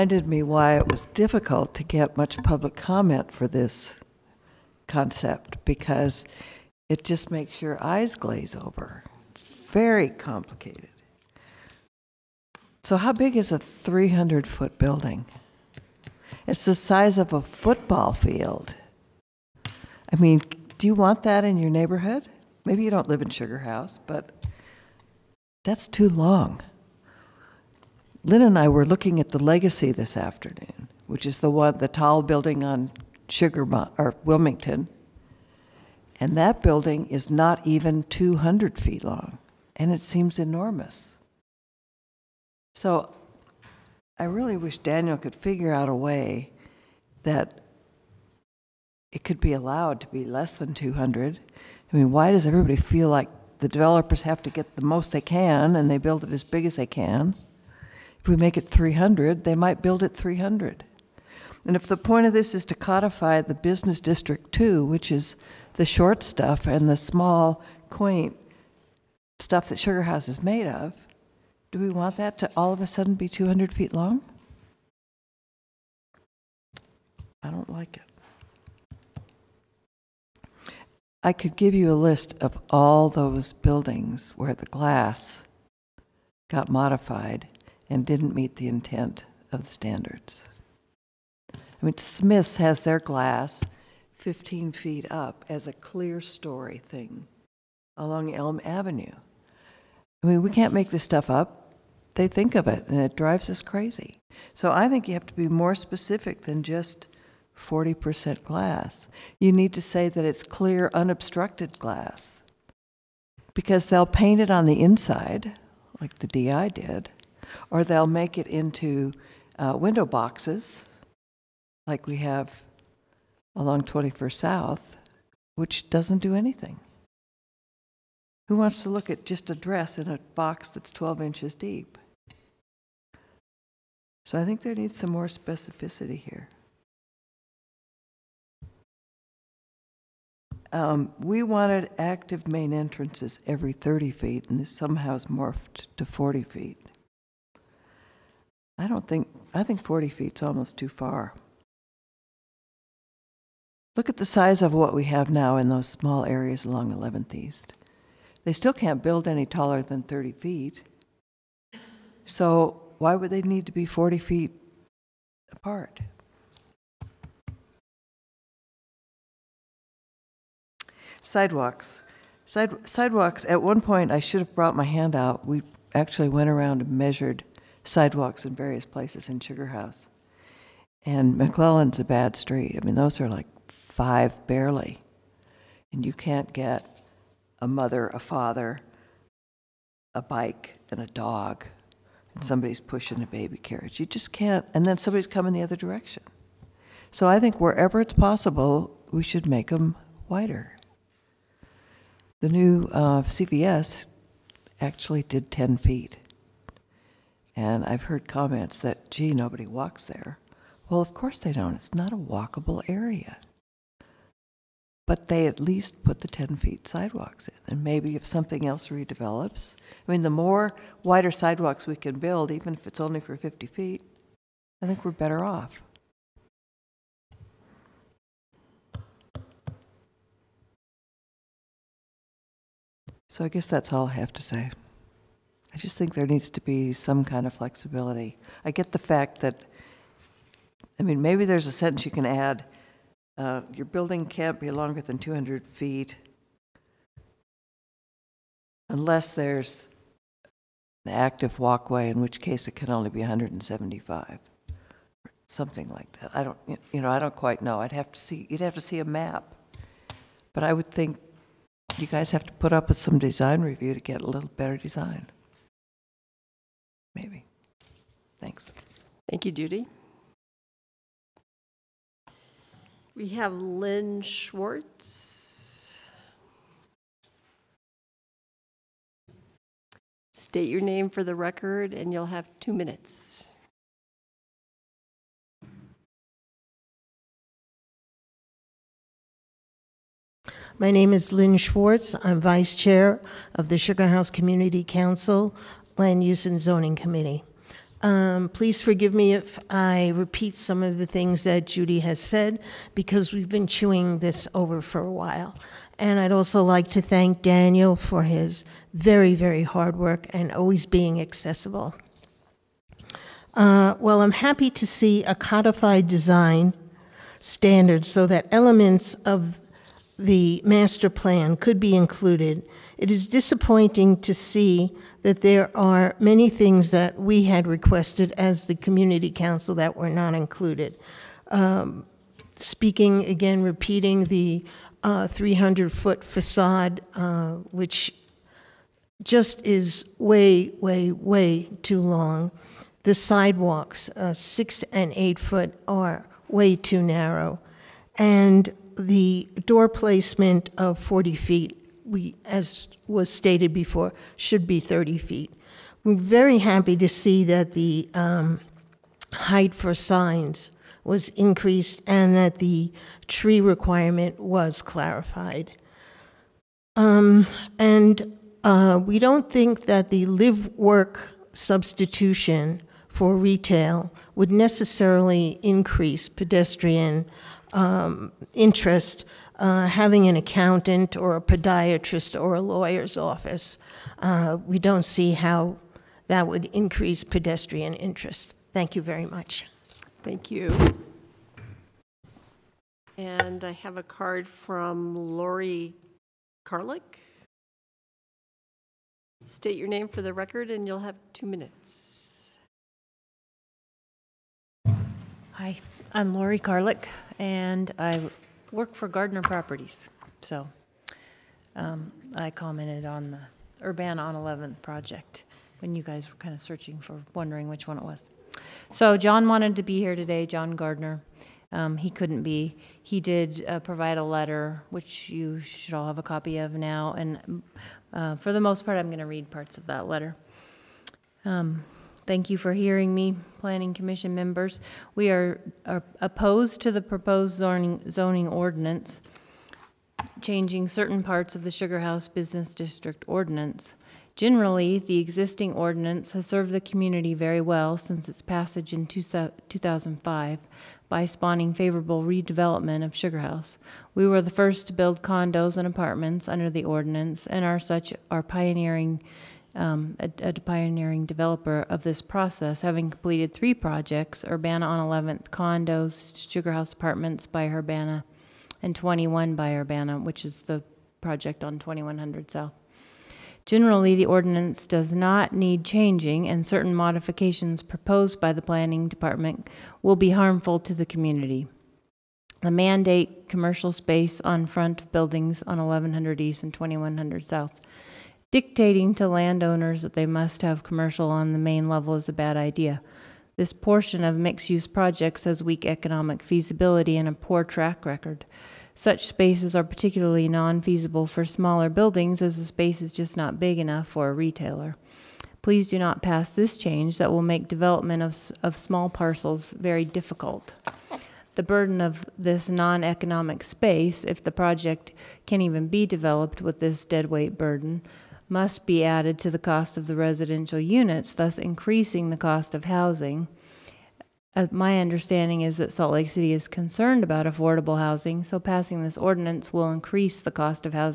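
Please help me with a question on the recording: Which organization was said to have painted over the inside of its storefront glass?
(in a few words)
DI.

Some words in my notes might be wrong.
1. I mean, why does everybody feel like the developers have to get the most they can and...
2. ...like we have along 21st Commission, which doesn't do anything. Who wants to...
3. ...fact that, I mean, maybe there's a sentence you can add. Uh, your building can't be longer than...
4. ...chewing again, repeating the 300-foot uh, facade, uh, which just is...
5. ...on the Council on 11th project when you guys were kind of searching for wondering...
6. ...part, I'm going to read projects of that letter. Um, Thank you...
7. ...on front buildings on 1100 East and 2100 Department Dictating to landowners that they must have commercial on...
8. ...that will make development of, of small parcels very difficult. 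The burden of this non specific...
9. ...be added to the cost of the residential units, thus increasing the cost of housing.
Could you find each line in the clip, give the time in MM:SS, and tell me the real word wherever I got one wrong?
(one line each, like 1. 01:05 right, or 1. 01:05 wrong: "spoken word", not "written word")
1. 00:51 right
2. 02:01 wrong: "South", not "Commission"
3. 03:58 right
4. 05:32 wrong: "speaking", not "chewing"
5. 06:53 wrong: "Urbana", not "Council"
6. 07:08 wrong: "parts", not "projects"
7. 08:04 wrong: "South", not "Department"
8. 08:27 wrong: "economic", not "specific"
9. 08:38 right.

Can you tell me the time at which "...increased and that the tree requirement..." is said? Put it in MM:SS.
06:01.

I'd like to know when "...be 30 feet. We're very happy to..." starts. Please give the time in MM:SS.
05:54.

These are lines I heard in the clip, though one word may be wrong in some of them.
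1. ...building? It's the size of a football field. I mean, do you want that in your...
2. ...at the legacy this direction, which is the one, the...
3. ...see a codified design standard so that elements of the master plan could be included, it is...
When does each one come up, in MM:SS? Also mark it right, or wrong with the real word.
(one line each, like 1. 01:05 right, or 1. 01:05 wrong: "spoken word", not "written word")
1. 00:14 right
2. 00:29 wrong: "afternoon", not "direction"
3. 05:14 right.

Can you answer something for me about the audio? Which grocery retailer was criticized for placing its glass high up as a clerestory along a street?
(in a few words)
Smith's.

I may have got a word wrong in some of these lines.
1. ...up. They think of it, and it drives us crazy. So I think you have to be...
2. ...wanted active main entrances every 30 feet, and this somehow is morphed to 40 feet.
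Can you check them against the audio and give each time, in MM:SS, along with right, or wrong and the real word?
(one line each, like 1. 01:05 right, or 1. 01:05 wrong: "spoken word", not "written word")
1. 01:41 right
2. 02:21 right.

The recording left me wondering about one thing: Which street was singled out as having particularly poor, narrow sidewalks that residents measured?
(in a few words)
McClelland.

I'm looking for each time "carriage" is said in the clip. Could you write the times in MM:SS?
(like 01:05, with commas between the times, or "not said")
03:13.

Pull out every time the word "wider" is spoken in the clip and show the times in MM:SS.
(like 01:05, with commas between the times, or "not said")
03:20, 03:41.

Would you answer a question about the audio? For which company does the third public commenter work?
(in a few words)
Gardner Properties.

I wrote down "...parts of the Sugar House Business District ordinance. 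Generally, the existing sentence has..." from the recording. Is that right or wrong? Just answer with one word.
wrong.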